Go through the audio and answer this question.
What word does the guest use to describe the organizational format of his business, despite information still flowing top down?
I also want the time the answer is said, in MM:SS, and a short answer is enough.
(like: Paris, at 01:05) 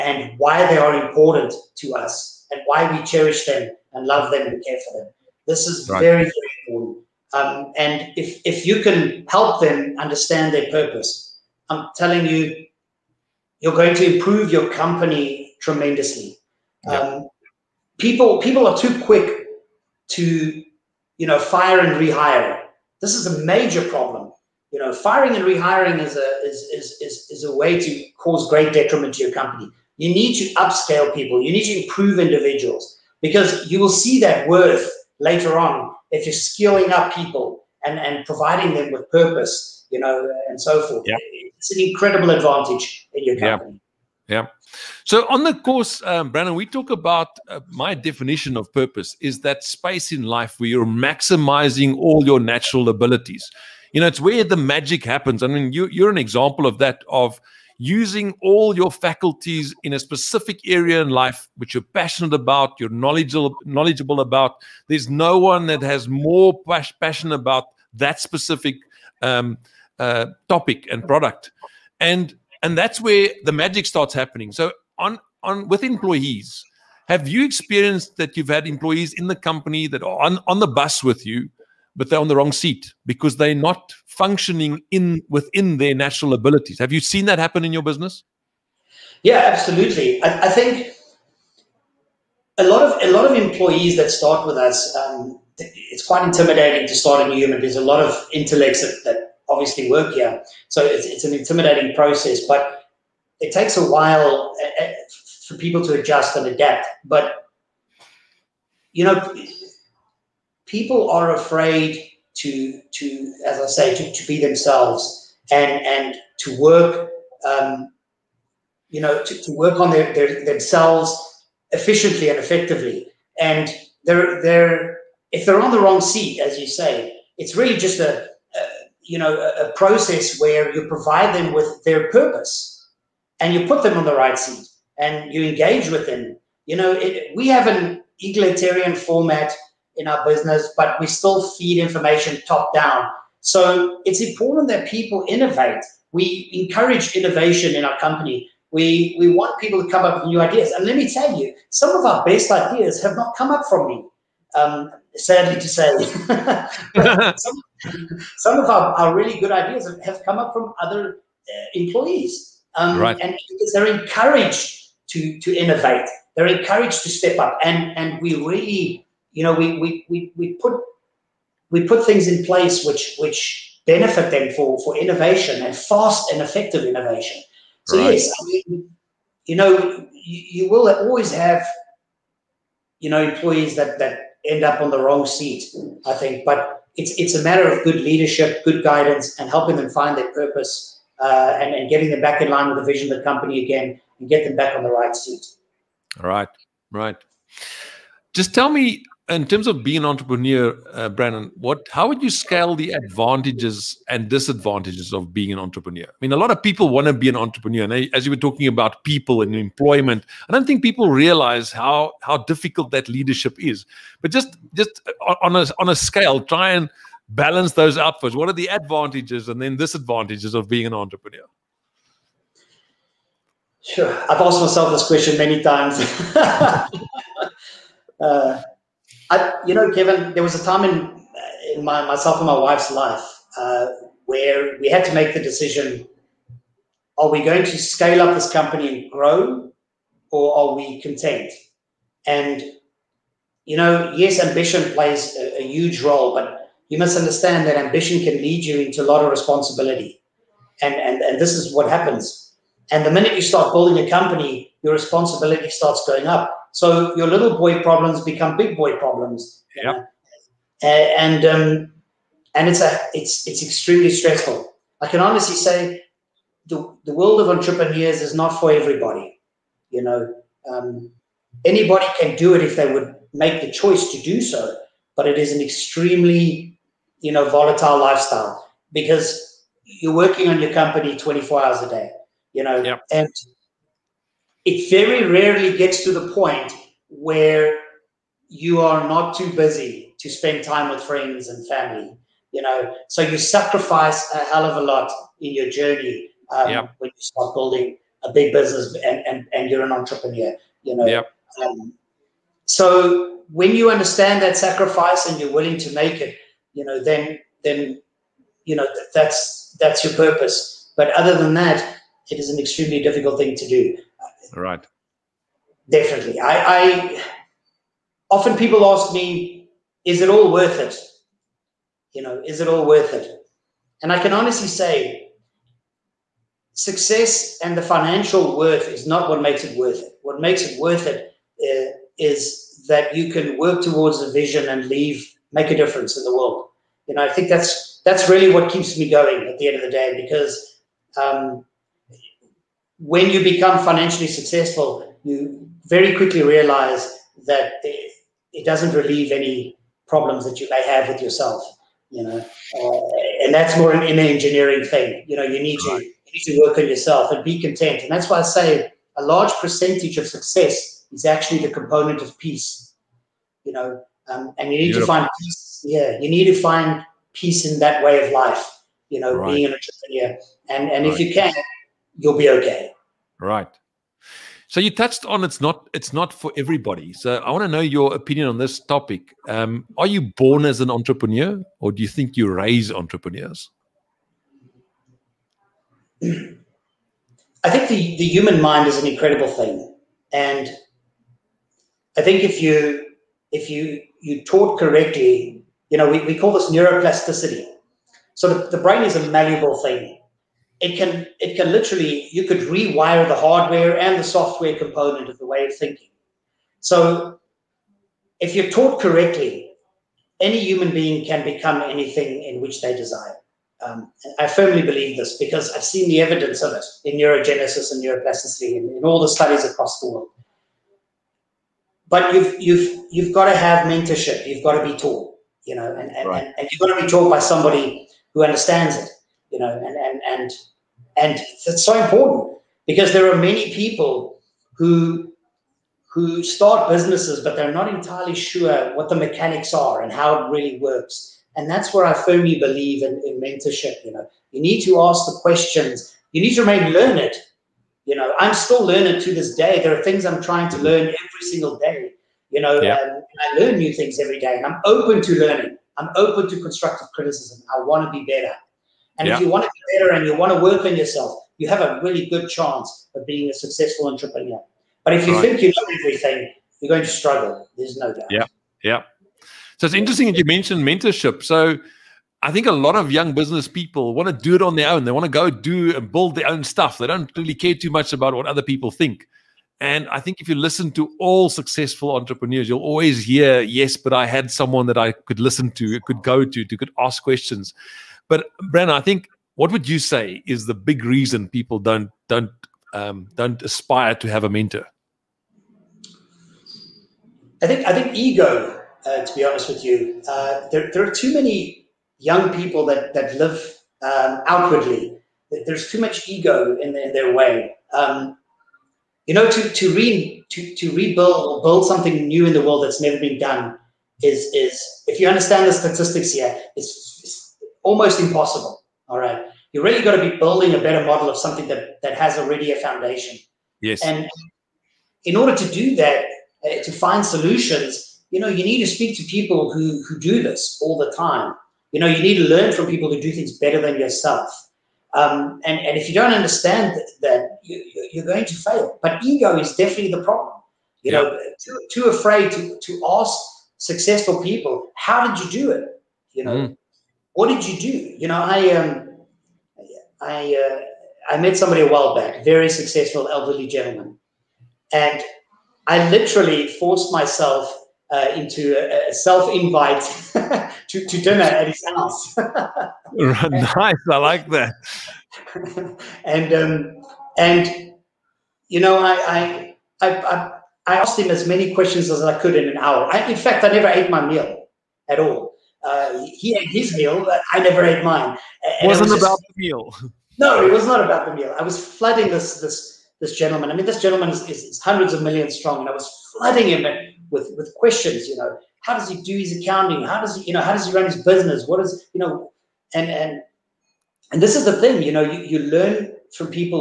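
egalitarian, at 02:18.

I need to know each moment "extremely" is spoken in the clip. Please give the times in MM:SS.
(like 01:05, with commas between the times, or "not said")
04:23, 04:35, 05:12.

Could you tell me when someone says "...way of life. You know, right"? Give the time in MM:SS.
06:08.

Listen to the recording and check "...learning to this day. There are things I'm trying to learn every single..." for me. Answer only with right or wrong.
right.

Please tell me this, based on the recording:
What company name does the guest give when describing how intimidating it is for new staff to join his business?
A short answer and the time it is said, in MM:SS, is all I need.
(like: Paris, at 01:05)
Nuhuman, at 01:37.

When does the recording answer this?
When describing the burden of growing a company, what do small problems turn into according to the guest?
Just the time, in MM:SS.
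04:18.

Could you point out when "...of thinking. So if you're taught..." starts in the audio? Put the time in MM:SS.
06:45.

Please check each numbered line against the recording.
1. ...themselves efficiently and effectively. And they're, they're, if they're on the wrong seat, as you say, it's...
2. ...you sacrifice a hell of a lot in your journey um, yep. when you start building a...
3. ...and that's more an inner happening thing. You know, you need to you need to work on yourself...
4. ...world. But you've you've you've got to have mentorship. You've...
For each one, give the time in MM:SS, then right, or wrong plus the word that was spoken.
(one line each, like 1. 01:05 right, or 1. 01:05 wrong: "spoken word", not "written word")
1. 02:00 right
2. 04:53 right
3. 05:53 wrong: "engineering", not "happening"
4. 07:00 right.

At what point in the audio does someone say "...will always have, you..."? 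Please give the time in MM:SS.
03:00.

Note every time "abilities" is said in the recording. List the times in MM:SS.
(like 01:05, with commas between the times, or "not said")
00:52, 01:26.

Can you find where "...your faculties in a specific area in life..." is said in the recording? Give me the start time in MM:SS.
00:58.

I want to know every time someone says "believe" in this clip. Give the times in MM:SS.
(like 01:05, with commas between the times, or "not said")
06:54, 07:22.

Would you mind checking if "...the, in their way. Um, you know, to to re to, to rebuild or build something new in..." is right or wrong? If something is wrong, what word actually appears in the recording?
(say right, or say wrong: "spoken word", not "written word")
right.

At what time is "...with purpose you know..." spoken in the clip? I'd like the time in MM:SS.
00:38.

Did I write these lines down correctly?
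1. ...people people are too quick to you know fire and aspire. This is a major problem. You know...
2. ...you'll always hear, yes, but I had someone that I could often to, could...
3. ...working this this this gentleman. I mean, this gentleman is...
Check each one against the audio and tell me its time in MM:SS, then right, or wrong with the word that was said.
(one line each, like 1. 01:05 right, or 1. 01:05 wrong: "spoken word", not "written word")
1. 00:17 wrong: "rehire", not "aspire"
2. 08:02 wrong: "listen", not "often"
3. 09:41 wrong: "flooding", not "working".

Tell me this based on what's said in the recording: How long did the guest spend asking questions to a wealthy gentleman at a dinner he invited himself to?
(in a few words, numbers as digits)
an hour.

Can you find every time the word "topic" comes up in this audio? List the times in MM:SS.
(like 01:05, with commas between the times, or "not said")
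01:10, 06:18.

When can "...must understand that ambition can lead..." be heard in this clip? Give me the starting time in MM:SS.
04:06.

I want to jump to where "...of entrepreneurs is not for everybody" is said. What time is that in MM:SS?
04:27.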